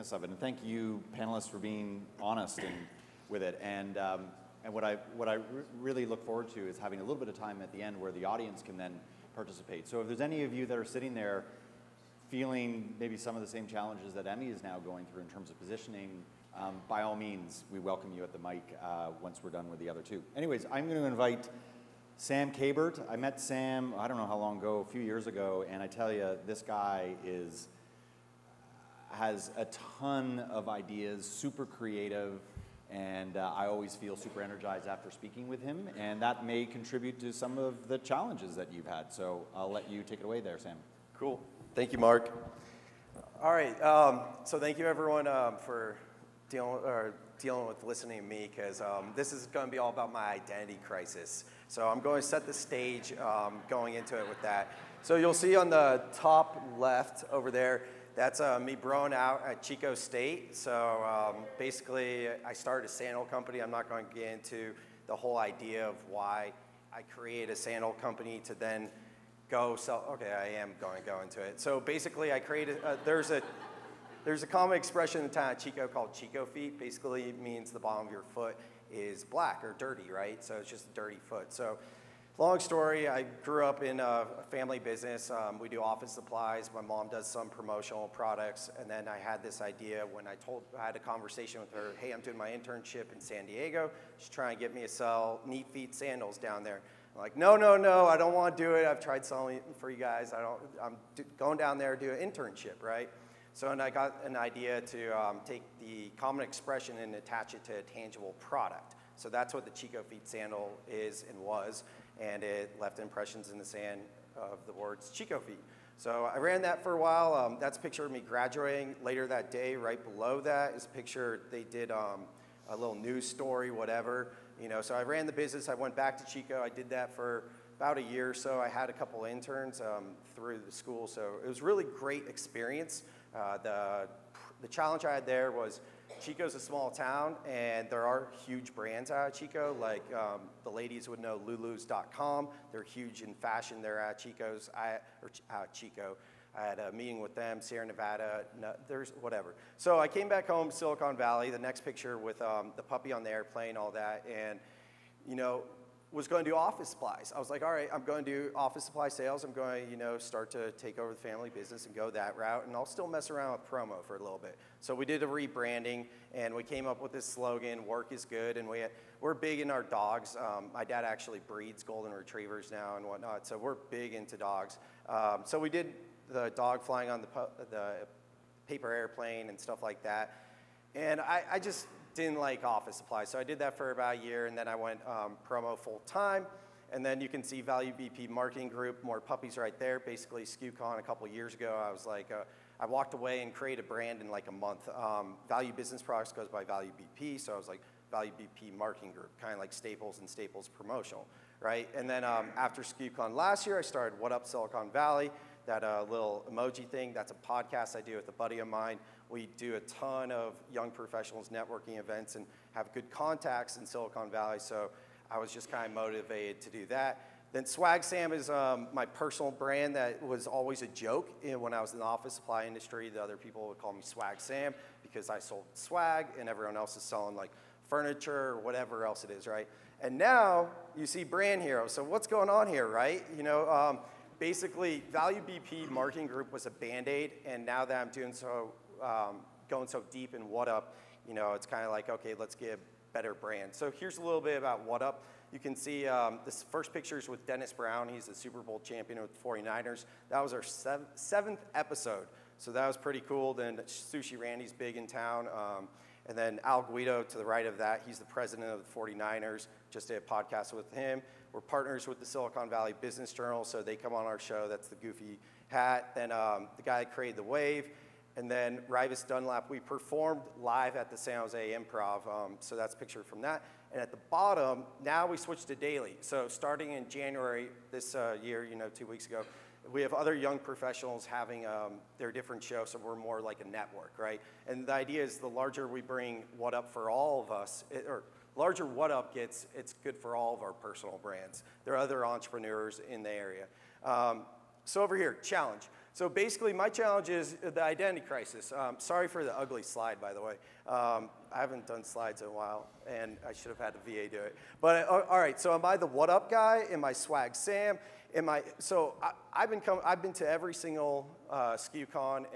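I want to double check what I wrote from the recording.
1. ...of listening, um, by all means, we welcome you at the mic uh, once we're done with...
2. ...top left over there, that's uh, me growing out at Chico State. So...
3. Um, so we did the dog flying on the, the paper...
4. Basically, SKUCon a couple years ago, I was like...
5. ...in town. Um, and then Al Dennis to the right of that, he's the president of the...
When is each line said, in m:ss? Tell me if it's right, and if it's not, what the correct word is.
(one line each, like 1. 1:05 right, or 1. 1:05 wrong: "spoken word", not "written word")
1. 0:15 wrong: "positioning", not "listening"
2. 0:56 right
3. 2:55 right
4. 3:09 right
5. 4:14 wrong: "Guido", not "Dennis".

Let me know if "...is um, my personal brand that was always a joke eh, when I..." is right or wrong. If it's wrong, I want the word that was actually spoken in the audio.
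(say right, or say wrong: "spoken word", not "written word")
right.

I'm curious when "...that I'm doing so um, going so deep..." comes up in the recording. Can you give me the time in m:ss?
3:57.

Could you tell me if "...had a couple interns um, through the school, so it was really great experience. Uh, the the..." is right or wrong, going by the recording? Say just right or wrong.
right.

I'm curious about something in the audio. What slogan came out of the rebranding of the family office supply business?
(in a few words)
Work is good.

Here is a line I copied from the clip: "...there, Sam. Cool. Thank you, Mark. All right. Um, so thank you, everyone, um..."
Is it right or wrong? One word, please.
right.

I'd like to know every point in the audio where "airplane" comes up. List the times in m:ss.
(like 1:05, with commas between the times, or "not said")
2:33, 2:58.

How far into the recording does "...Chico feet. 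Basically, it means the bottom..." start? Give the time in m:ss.
1:16.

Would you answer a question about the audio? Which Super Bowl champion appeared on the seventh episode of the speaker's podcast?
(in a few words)
Dennis Brown.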